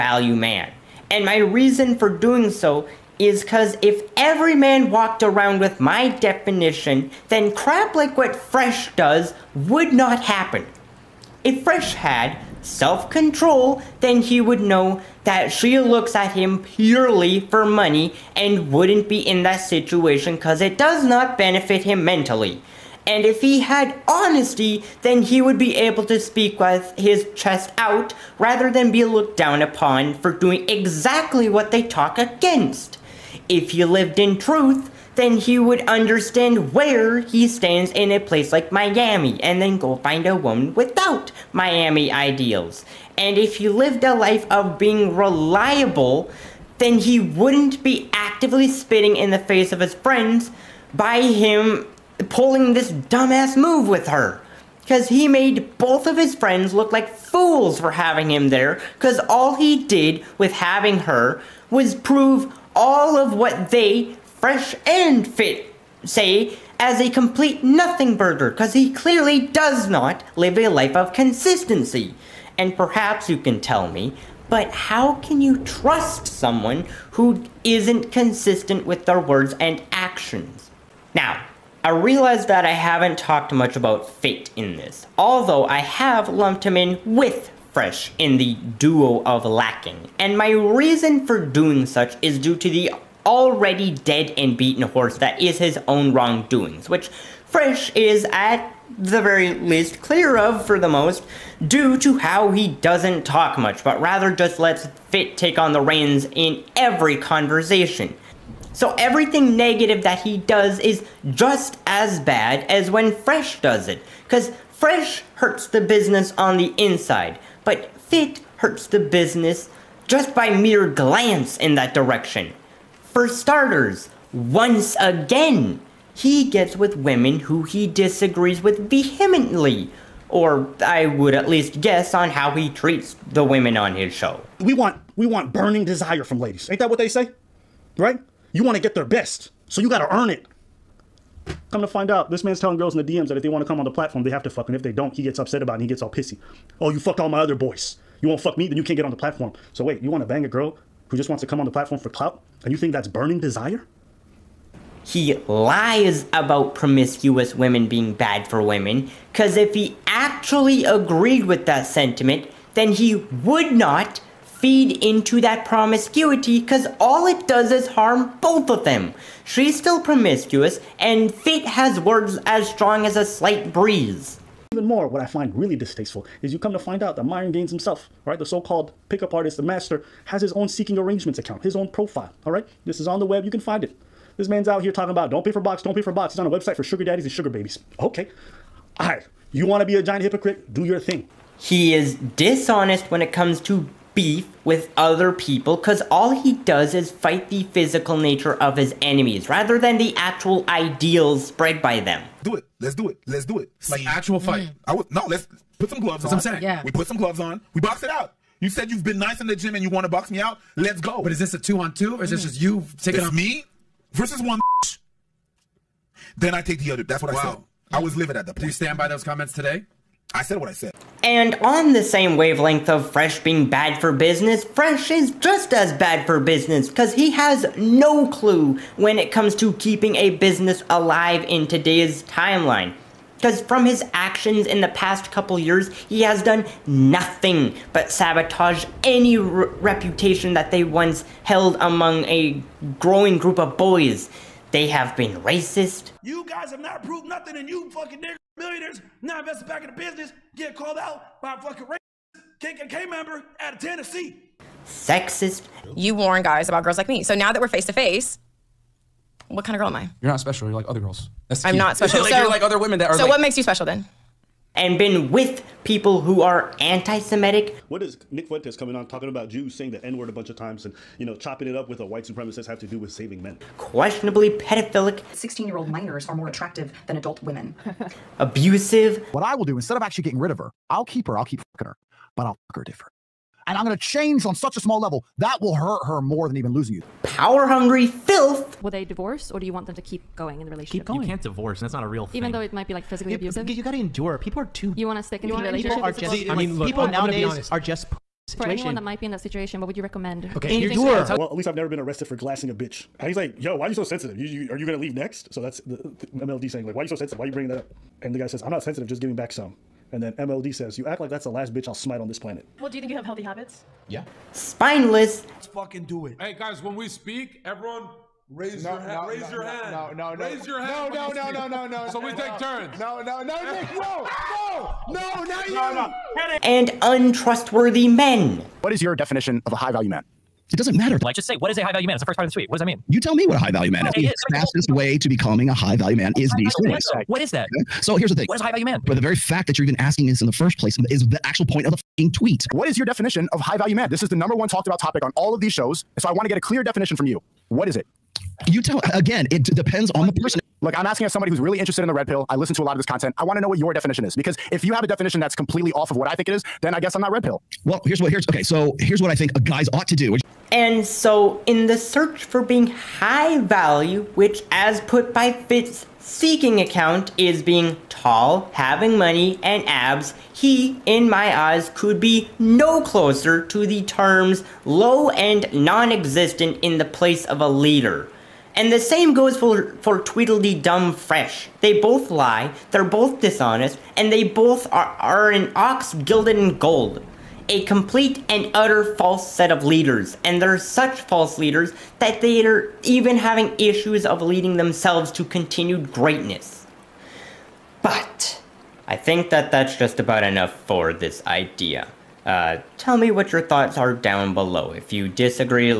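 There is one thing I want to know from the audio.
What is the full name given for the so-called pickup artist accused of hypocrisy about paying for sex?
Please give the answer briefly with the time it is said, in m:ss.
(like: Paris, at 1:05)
Myron Gaines, at 2:57.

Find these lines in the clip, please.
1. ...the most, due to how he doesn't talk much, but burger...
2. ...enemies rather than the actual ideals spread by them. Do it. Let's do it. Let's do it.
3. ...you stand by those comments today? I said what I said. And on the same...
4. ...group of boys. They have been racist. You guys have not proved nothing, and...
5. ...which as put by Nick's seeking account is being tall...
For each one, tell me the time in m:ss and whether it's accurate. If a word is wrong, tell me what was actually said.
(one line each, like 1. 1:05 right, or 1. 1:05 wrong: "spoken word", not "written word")
1. 1:40 wrong: "rather", not "burger"
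2. 3:19 right
3. 3:38 right
4. 4:03 right
5. 6:04 wrong: "Fit", not "Nick".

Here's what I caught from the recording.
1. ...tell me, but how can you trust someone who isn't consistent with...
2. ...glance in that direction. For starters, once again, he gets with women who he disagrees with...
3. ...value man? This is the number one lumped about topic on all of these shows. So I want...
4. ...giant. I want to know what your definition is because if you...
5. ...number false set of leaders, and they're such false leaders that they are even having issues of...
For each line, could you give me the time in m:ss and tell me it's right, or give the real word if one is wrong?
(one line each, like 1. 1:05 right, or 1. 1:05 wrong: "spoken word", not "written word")
1. 1:13 right
2. 2:00 right
3. 5:43 wrong: "talked", not "lumped"
4. 5:53 wrong: "content", not "giant"
5. 6:28 wrong: "utter", not "number".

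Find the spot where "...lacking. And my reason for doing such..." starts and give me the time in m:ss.
1:29.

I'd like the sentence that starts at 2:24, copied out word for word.
And if they don't, he gets upset about it and he gets all pissy.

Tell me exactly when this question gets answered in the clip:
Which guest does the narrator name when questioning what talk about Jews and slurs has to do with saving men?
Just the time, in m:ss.
4:28.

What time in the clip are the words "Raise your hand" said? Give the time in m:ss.
5:20.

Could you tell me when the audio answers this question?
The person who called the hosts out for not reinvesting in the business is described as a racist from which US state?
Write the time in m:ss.
4:13.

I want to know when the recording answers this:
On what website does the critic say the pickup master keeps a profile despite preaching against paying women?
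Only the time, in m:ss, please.
3:00.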